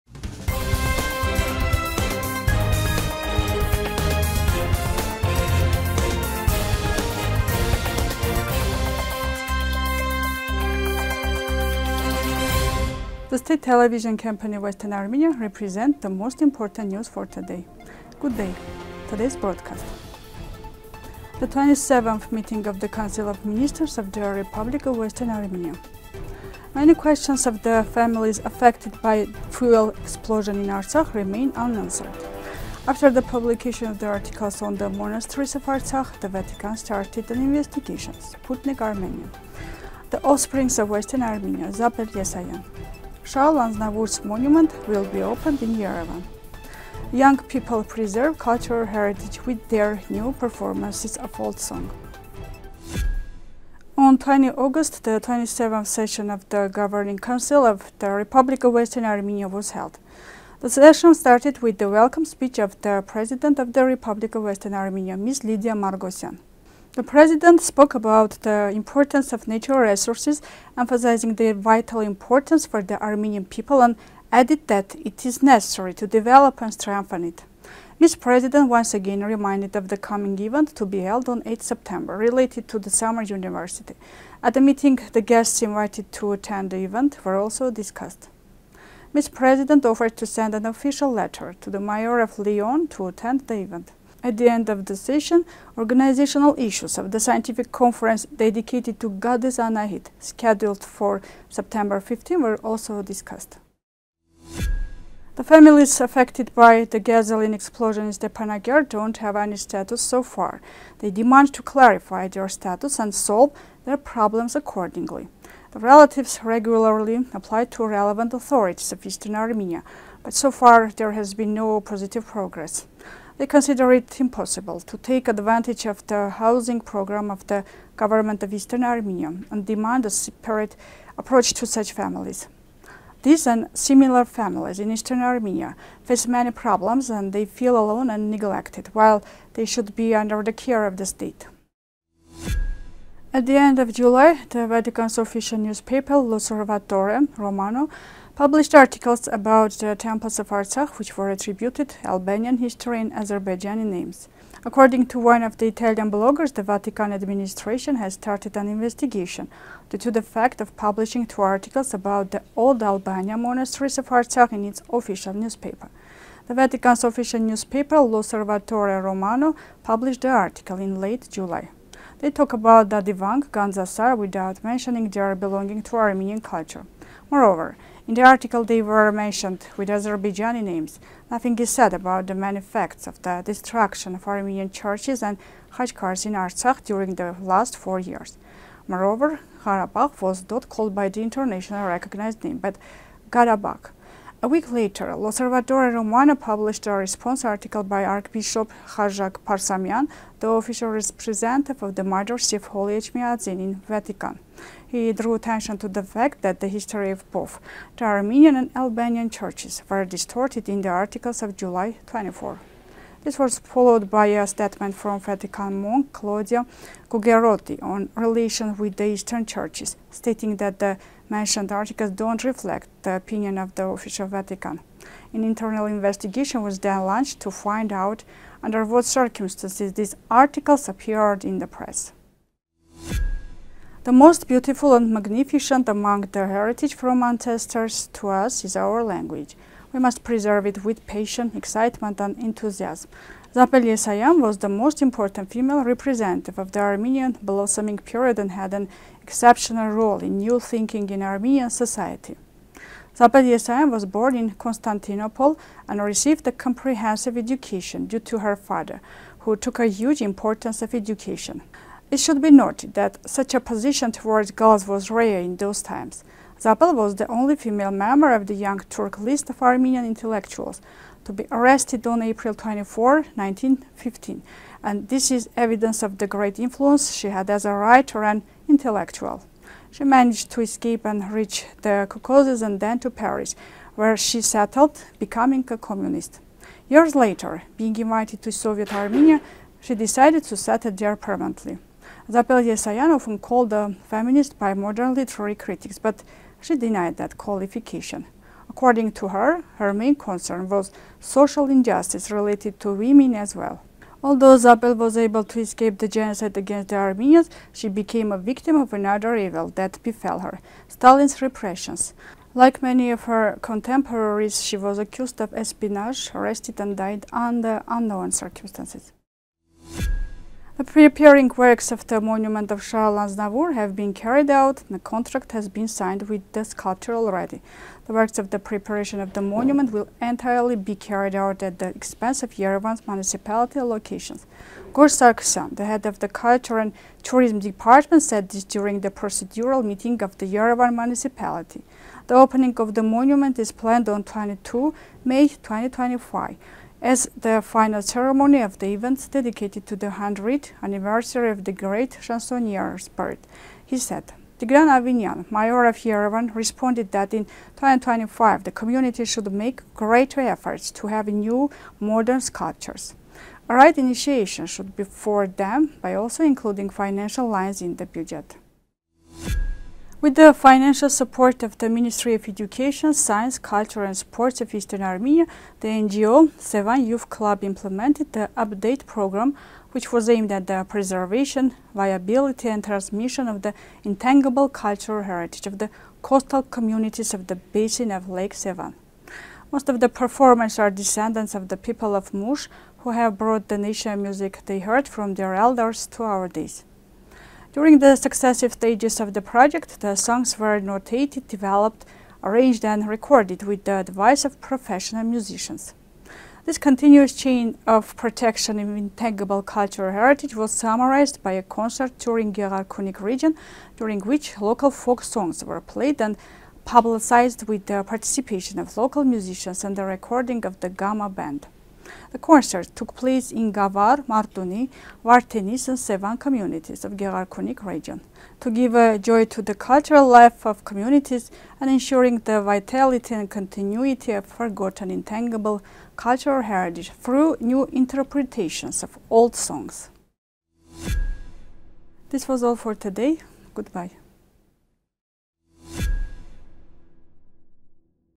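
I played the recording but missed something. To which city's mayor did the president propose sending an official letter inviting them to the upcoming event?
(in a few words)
Lyon.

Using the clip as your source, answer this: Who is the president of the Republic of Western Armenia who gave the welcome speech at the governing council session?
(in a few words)
Lydia Margosyan.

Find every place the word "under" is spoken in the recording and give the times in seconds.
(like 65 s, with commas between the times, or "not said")
140 s, 228 s, 317 s.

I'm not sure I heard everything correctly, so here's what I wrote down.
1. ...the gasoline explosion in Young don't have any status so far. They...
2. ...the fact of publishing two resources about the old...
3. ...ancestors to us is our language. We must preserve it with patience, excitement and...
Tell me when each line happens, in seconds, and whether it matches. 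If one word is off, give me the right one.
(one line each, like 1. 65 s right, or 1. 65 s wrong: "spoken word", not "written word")
1. 106 s wrong: "Stepanakert", not "Young"
2. 160 s wrong: "articles", not "resources"
3. 237 s right.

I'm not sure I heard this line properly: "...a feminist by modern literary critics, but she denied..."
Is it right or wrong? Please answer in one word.
right.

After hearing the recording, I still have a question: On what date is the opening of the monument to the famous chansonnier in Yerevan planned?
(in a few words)
22 May 2025.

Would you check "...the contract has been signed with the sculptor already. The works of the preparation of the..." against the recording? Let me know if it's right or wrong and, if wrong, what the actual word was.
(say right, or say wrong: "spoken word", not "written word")
right.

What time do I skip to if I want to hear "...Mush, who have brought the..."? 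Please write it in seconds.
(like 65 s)
392 s.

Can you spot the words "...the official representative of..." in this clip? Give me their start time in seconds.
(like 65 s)
200 s.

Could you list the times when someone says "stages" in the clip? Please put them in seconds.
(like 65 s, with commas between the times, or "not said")
398 s.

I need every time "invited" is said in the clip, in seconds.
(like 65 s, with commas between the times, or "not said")
85 s, 287 s.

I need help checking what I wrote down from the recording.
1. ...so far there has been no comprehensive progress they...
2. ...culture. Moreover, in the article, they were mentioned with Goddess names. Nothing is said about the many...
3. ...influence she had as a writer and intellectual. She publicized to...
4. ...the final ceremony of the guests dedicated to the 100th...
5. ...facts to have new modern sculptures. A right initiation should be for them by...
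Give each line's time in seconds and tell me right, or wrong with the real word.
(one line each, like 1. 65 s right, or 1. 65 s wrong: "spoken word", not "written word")
1. 120 s wrong: "positive", not "comprehensive"
2. 176 s wrong: "Azerbaijani", not "Goddess"
3. 276 s wrong: "managed", not "publicized"
4. 347 s wrong: "events", not "guests"
5. 360 s wrong: "efforts", not "facts".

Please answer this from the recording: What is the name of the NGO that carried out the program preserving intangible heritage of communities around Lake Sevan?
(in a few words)
Sevan Youth Club.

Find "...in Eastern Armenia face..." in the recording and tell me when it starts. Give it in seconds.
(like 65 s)
134 s.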